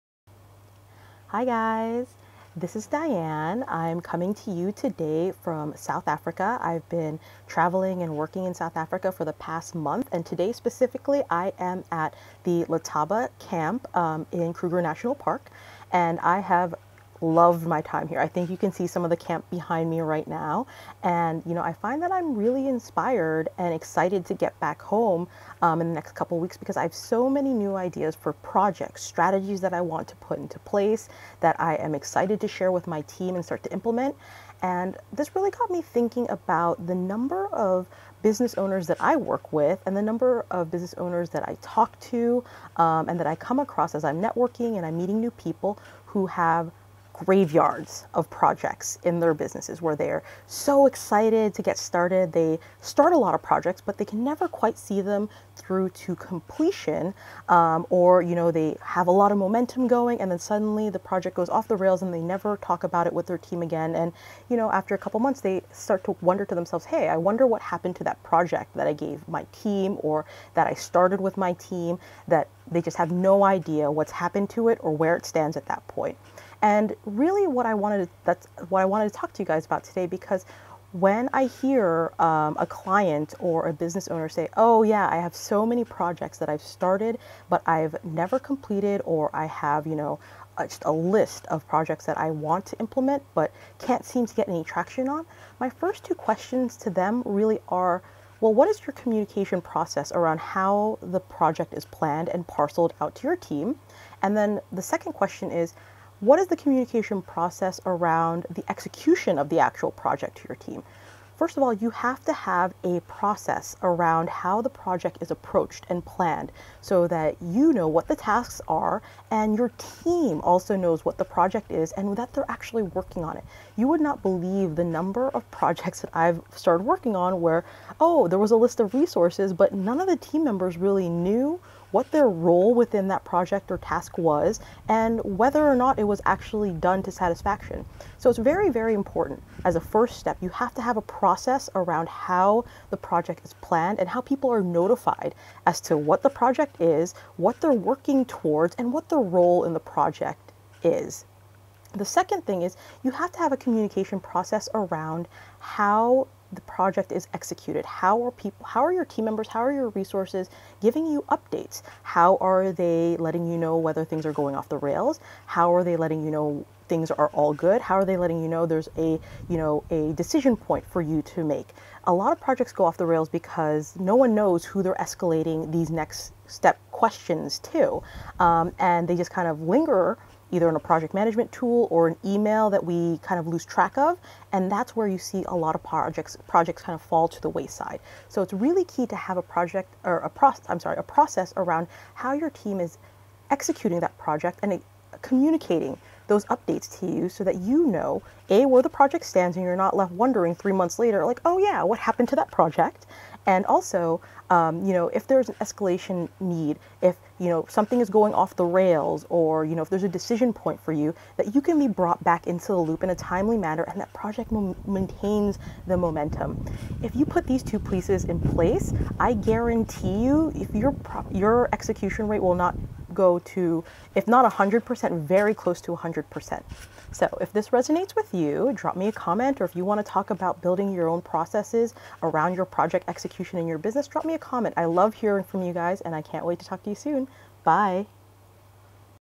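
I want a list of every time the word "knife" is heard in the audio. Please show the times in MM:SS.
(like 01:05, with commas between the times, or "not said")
not said.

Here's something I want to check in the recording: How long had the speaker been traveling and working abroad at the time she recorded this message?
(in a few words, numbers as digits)
the past month.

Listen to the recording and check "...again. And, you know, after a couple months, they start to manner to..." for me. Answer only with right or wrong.
wrong.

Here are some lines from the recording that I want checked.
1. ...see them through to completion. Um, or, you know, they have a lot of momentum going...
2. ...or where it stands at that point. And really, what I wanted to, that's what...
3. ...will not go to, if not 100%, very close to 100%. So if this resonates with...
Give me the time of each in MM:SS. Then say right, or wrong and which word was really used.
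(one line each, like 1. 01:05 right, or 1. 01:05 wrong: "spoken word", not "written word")
1. 00:54 right
2. 01:14 right
3. 03:42 right.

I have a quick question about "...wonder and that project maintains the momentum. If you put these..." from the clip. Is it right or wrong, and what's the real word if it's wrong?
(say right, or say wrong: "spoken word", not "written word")
wrong: "manner", not "wonder".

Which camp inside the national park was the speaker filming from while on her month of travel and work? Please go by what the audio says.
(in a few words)
Letaba camp.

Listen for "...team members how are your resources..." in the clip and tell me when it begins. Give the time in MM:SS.
02:39.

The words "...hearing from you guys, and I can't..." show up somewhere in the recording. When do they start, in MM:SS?
03:55.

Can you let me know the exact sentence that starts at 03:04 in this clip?
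And that's where you see a lot of projects projects kind of fall to the wayside.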